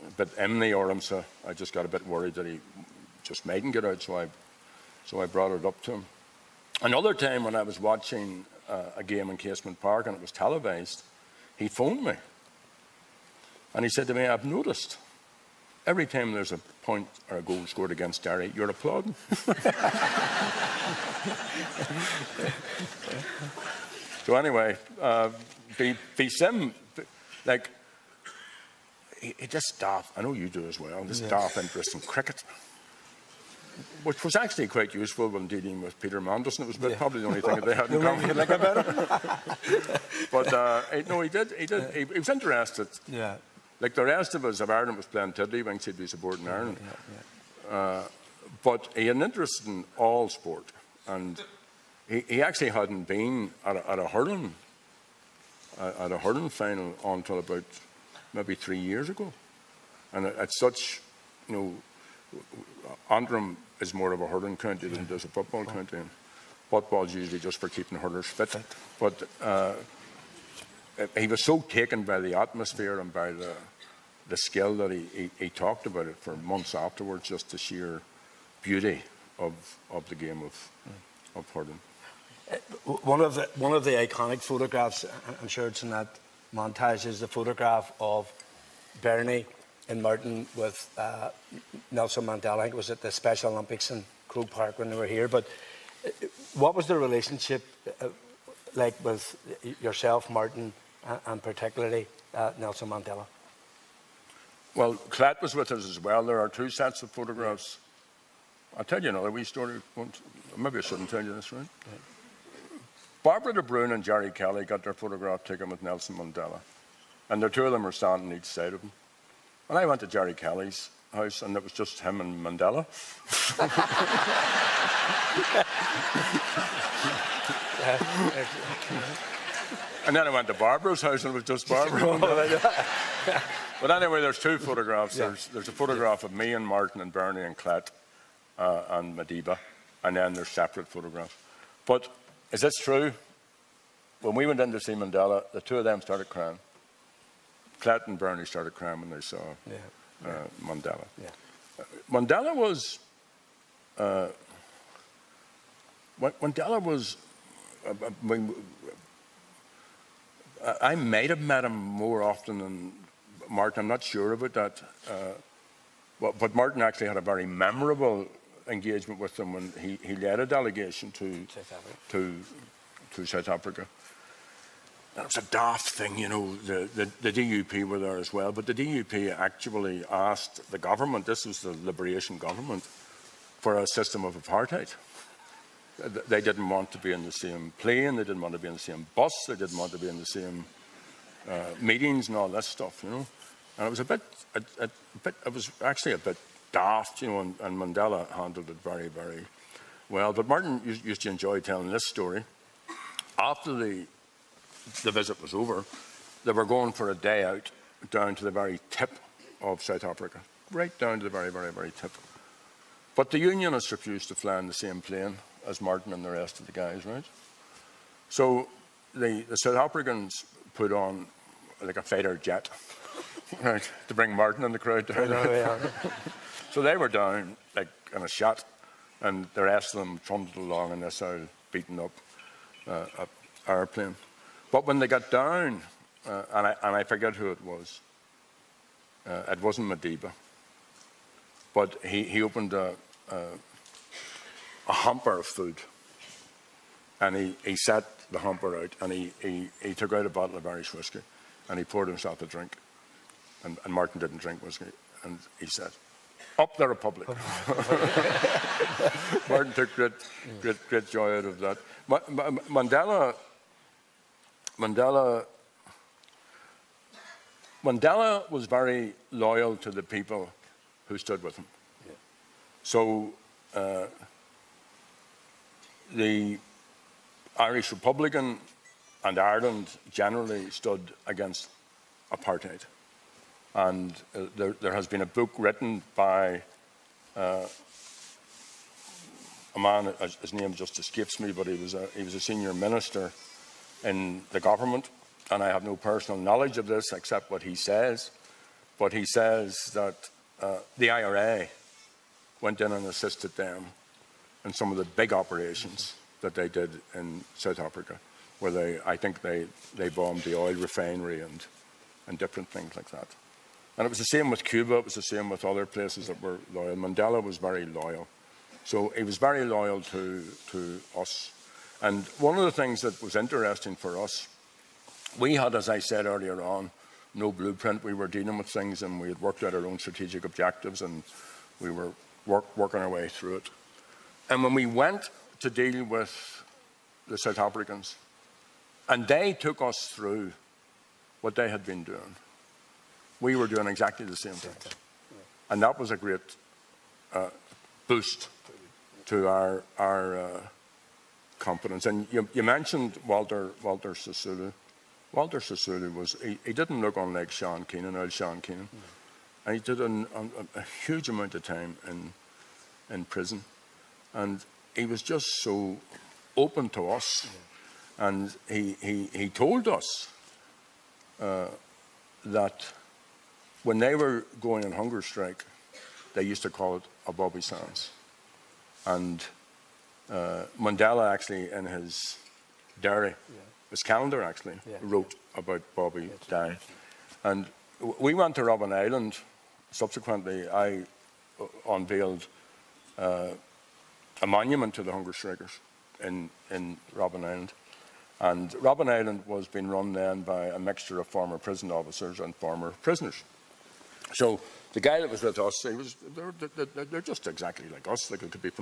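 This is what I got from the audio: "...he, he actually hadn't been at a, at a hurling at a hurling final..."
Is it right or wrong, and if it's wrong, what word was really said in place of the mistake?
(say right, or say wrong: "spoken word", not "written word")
right.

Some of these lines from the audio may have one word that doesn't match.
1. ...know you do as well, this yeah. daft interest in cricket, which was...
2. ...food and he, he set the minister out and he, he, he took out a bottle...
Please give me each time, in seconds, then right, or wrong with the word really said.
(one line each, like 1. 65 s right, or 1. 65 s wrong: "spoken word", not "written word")
1. 30 s right
2. 245 s wrong: "hamper", not "minister".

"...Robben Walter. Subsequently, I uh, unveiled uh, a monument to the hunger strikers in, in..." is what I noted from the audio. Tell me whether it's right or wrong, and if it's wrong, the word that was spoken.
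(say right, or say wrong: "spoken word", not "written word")
wrong: "Island", not "Walter".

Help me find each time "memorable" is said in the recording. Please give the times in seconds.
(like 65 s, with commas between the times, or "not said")
167 s.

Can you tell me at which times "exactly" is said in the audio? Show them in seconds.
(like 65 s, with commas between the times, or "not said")
343 s, 407 s.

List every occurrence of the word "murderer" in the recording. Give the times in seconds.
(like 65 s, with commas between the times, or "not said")
not said.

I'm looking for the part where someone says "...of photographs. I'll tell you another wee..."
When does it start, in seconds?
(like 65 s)
107 s.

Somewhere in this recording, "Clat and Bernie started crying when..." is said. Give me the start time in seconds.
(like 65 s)
147 s.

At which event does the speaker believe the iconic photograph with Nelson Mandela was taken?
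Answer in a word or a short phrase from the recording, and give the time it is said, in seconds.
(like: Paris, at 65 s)
Special Olympics, at 93 s.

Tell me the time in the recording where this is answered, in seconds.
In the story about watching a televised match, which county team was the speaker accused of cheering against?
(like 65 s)
18 s.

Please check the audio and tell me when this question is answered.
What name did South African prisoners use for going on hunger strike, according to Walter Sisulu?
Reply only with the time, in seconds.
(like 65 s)
377 s.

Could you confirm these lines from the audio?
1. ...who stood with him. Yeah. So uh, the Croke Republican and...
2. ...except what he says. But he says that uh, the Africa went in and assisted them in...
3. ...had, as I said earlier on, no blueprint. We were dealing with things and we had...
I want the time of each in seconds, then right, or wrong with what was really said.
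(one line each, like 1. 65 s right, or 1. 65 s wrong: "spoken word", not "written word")
1. 271 s wrong: "Irish", not "Croke"
2. 297 s wrong: "IRA", not "Africa"
3. 325 s right.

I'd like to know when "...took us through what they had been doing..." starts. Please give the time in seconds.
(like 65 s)
339 s.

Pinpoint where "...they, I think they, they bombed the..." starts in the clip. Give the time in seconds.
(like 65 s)
308 s.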